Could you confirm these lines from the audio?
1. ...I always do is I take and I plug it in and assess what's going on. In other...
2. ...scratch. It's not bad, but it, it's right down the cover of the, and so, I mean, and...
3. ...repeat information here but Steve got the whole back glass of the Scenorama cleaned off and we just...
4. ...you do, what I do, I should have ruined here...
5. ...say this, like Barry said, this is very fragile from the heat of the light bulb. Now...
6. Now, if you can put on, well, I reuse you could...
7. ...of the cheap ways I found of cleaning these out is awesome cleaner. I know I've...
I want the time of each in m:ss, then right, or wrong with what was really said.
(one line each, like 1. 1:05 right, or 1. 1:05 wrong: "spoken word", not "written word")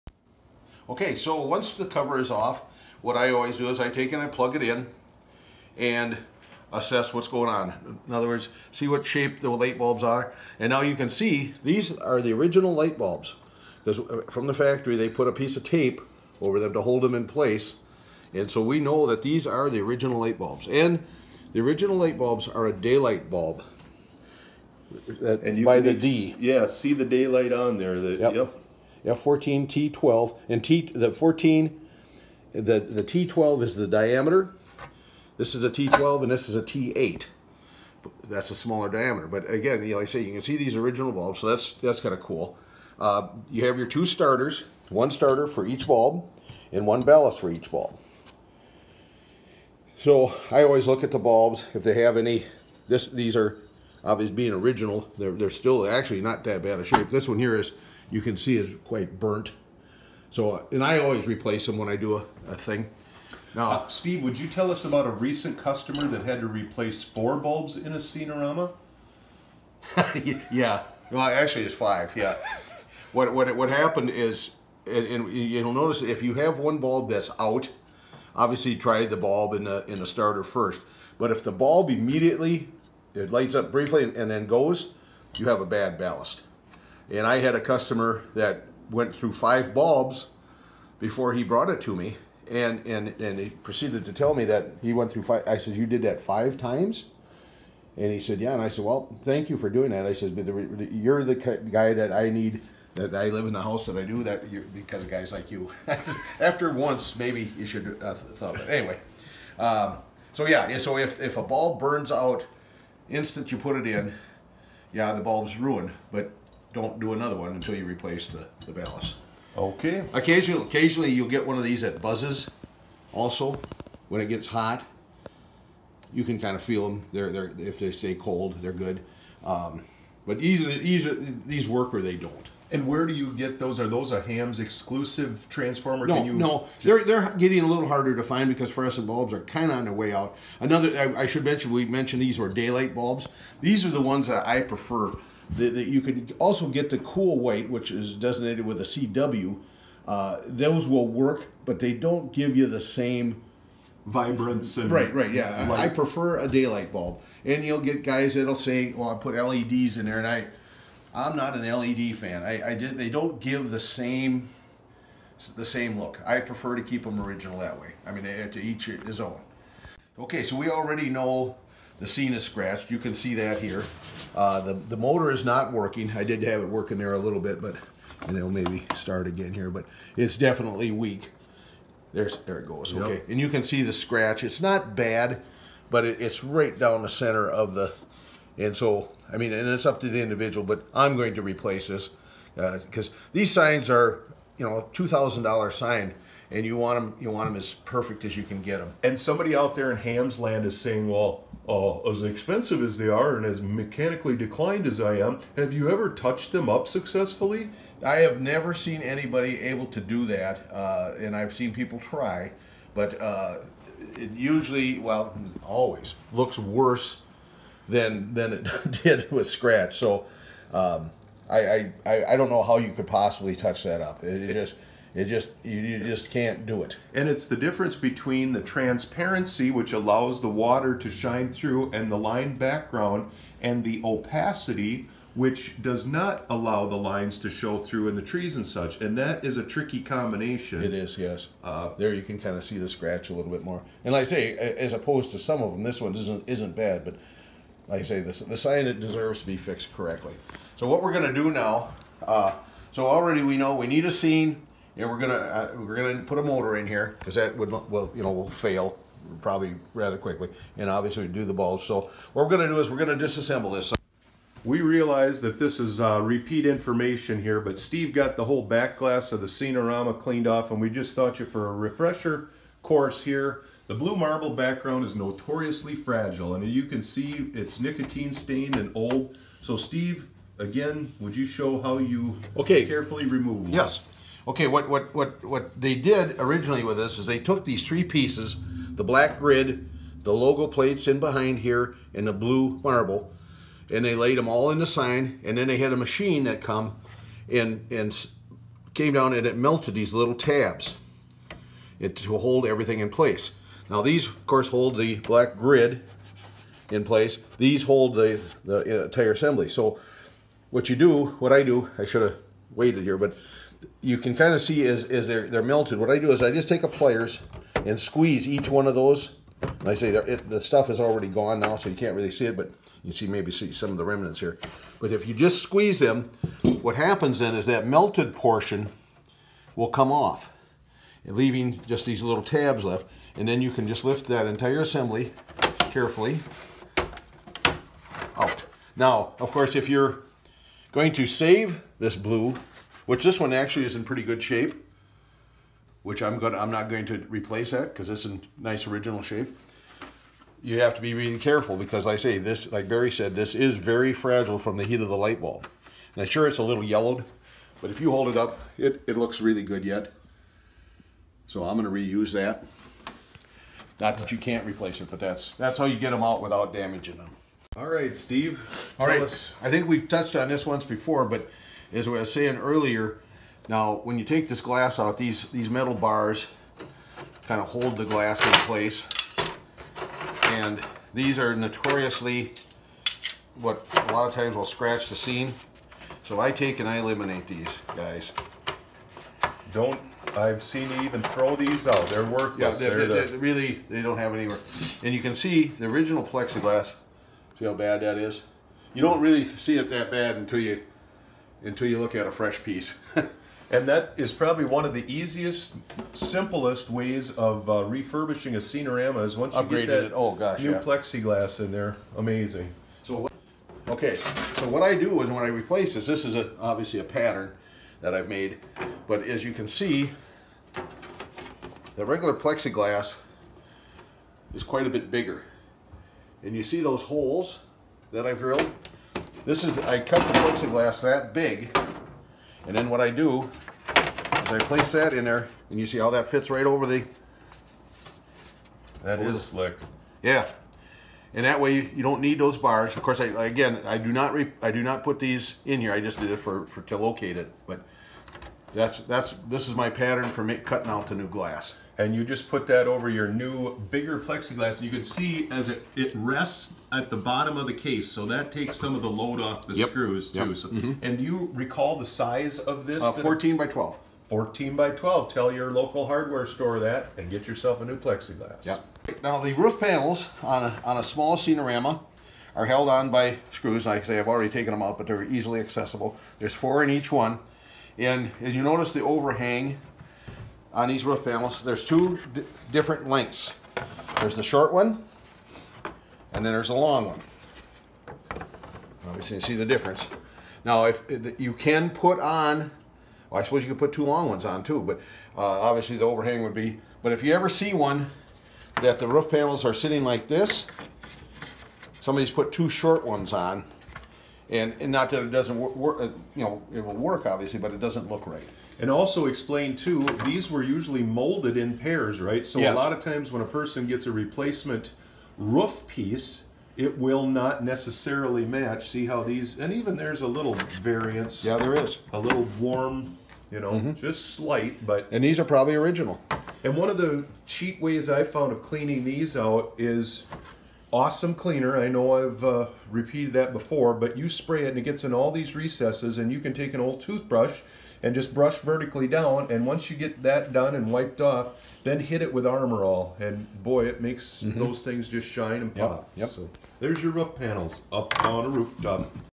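1. 0:03 right
2. 3:03 wrong: "center", not "cover"
3. 4:26 right
4. 5:10 wrong: "waited", not "ruined"
5. 5:52 right
6. 8:10 wrong: "suppose", not "reuse"
7. 8:46 right.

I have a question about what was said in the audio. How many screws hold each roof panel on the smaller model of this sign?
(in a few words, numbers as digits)
4.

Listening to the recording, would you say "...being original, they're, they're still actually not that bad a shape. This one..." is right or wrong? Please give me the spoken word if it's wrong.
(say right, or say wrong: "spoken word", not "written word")
right.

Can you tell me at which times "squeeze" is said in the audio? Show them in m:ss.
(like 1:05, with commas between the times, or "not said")
5:17, 5:25.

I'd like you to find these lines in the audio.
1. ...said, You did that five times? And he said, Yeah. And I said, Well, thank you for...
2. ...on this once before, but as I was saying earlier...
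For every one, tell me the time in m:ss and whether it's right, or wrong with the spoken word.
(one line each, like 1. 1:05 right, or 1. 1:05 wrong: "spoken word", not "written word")
1. 1:35 right
2. 6:10 right.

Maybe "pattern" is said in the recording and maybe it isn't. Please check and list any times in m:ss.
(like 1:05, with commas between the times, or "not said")
6:57, 7:29.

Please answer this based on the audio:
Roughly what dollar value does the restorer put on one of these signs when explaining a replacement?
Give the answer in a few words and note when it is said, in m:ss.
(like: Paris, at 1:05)
$2,000, at 3:14.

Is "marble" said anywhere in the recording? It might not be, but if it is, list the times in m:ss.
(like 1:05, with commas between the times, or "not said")
4:34, 4:52.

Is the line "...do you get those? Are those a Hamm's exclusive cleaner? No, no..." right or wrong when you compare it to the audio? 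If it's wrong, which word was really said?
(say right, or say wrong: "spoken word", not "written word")
wrong: "transformer", not "cleaner".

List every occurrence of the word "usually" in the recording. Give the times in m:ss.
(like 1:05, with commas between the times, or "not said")
3:34, 8:30.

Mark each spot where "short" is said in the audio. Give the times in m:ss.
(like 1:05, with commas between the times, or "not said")
8:04, 8:22.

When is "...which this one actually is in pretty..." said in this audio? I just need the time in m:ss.
5:43.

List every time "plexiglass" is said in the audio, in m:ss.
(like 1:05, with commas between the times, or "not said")
6:36, 6:50, 7:02, 7:10, 7:34, 7:47.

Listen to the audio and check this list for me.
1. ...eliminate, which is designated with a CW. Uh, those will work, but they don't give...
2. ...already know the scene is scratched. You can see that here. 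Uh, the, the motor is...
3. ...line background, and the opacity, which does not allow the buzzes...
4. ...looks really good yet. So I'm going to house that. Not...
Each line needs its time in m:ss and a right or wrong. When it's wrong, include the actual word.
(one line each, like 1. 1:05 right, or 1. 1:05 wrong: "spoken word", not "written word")
1. 2:27 wrong: "white", not "eliminate"
2. 2:50 right
3. 3:52 wrong: "lines", not "buzzes"
4. 5:59 wrong: "reuse", not "house".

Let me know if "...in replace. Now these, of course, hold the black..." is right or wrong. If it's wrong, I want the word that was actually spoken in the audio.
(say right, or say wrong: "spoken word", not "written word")
wrong: "place", not "replace".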